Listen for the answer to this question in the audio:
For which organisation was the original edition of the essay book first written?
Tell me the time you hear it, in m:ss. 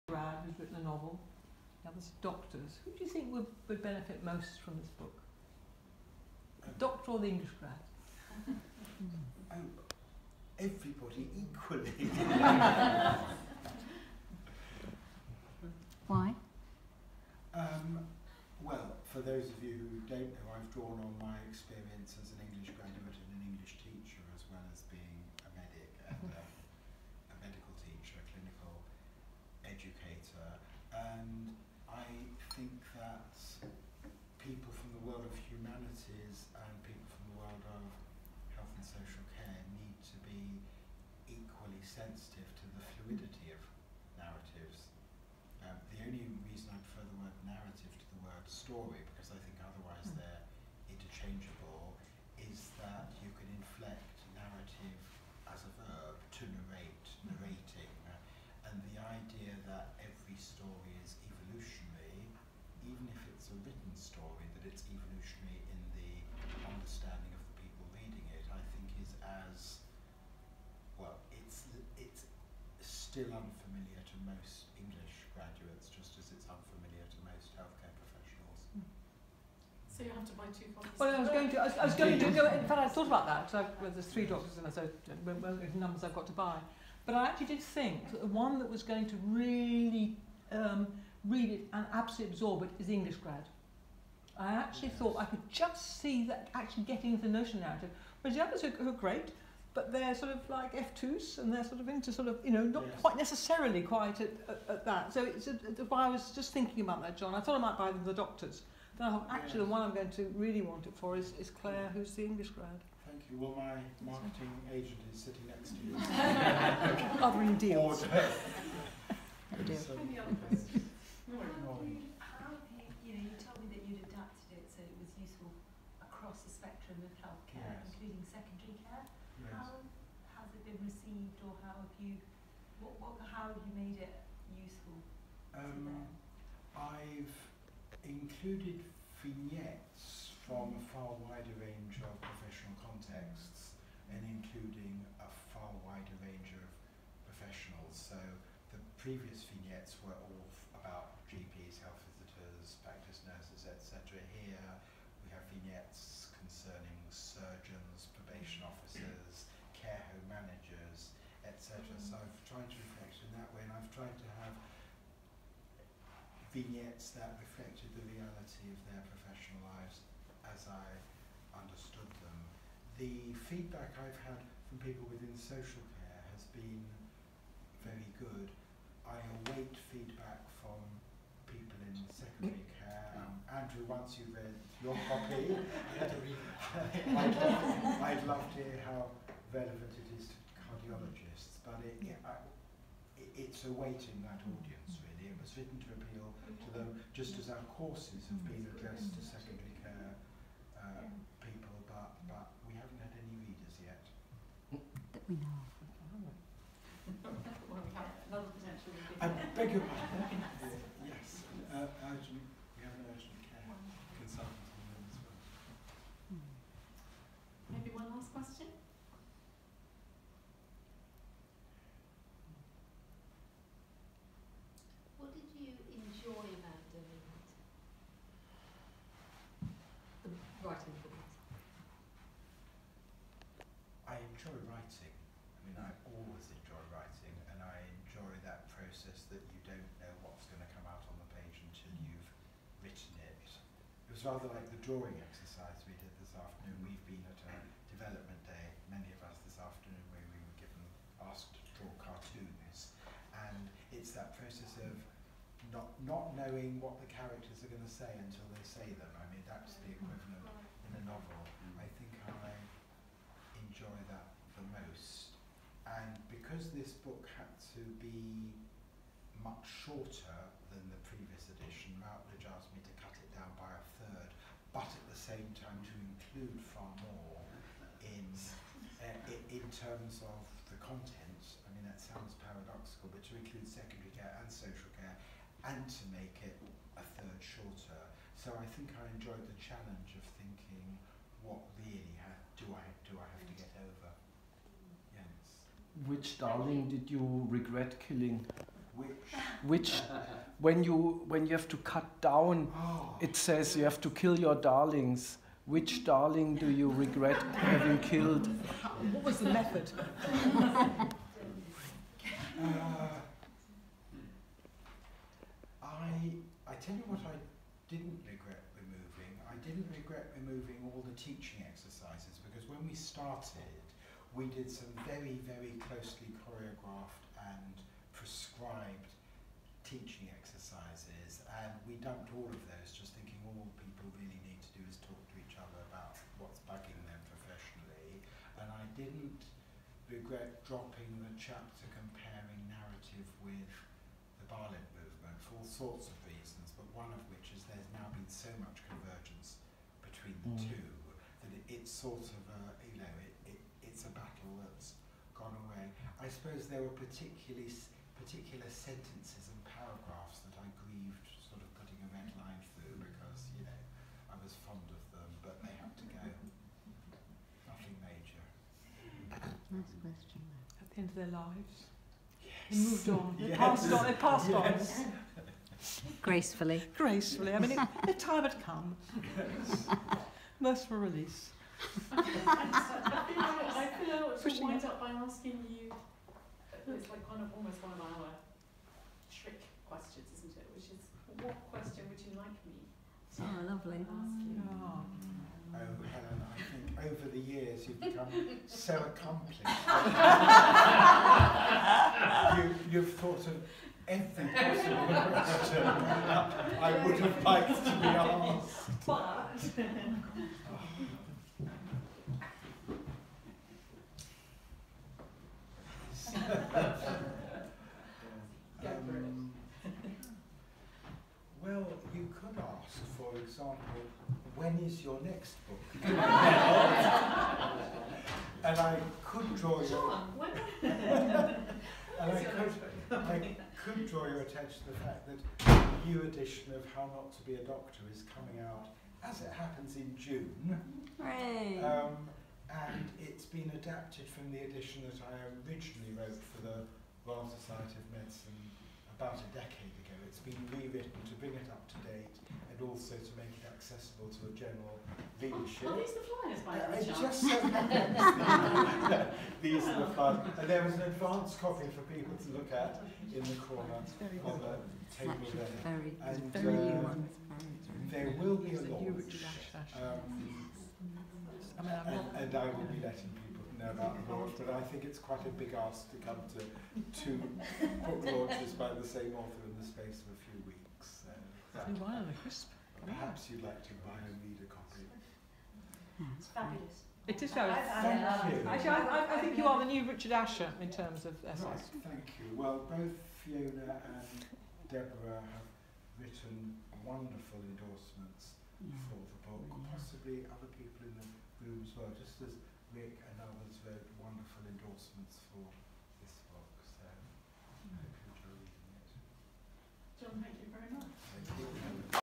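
7:27.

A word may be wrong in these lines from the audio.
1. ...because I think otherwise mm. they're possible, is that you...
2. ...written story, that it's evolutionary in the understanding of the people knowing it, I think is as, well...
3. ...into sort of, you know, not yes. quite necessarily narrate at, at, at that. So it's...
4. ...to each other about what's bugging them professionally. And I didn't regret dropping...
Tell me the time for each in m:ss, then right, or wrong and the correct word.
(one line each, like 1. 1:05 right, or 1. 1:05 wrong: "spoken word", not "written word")
1. 0:49 wrong: "interchangeable", not "possible"
2. 1:03 wrong: "reading", not "knowing"
3. 1:41 wrong: "quite", not "narrate"
4. 5:35 right.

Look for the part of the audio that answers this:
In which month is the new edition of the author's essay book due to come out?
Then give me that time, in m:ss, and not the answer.
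7:20.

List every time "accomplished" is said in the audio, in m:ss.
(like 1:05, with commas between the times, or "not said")
6:38.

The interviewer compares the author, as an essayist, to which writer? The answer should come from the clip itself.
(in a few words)
Richard Asher.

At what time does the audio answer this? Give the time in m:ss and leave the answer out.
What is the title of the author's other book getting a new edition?
7:16.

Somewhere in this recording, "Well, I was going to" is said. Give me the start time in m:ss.
1:20.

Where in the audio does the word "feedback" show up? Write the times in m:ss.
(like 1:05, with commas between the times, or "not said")
2:53, 2:59.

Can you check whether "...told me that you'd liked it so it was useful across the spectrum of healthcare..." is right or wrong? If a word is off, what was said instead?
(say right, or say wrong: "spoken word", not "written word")
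wrong: "adapted", not "liked".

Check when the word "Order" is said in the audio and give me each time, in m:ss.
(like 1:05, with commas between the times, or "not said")
1:58.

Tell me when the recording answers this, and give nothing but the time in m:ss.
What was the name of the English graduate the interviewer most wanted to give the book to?
1:51.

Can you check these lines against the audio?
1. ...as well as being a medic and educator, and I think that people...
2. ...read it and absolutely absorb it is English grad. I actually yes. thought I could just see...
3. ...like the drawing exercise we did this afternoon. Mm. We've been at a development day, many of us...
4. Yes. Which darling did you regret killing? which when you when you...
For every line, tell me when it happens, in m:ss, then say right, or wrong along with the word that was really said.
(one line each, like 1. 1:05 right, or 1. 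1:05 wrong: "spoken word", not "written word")
1. 0:24 right
2. 1:31 right
3. 4:04 right
4. 4:55 right.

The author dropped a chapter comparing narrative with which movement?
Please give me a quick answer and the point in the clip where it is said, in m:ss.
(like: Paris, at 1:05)
Balint movement, at 5:44.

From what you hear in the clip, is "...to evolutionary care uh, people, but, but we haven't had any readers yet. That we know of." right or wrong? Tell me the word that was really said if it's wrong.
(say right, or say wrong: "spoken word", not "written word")
wrong: "secondary", not "evolutionary".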